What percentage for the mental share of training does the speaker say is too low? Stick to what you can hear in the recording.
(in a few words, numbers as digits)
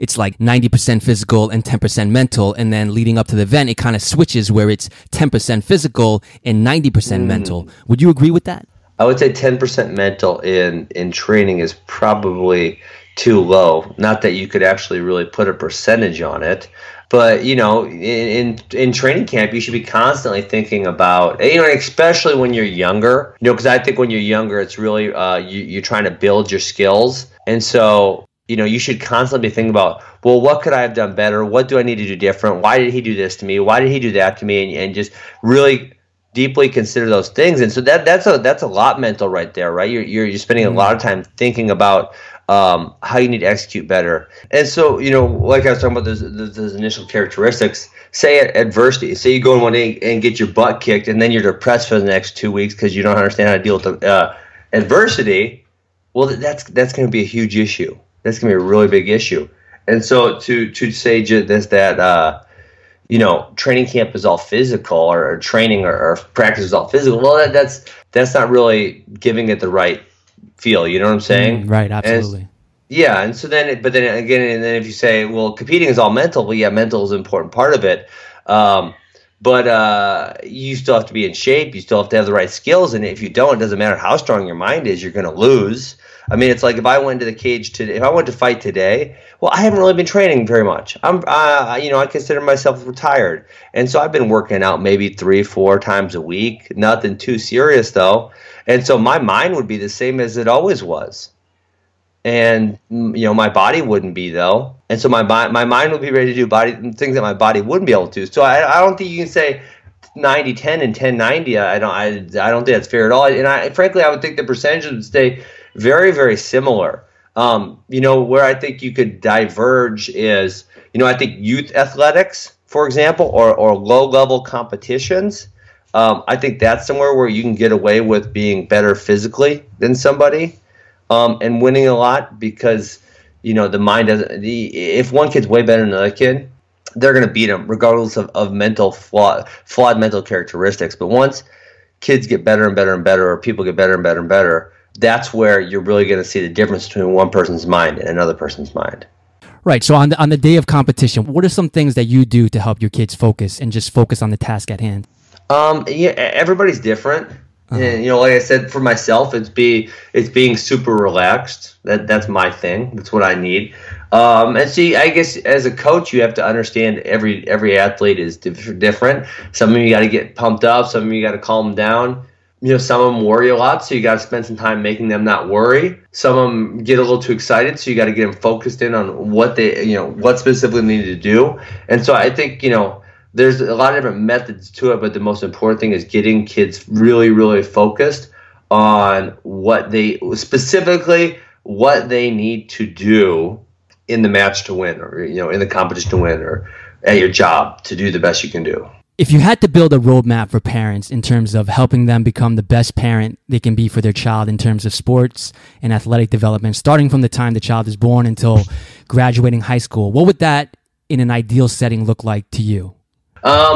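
10%.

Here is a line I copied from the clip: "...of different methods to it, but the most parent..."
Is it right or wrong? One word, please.
wrong.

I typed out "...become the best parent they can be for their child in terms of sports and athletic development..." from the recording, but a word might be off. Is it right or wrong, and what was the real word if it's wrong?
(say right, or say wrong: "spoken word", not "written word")
right.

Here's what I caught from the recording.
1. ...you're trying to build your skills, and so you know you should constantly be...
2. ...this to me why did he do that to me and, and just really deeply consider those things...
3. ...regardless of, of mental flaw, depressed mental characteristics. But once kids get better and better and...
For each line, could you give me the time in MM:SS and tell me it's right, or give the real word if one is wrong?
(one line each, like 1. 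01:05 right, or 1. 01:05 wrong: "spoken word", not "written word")
1. 00:25 right
2. 00:33 right
3. 02:17 wrong: "flawed", not "depressed".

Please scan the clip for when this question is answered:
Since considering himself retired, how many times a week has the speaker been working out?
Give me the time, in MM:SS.
01:35.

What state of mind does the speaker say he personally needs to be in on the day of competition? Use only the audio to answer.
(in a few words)
Super relaxed.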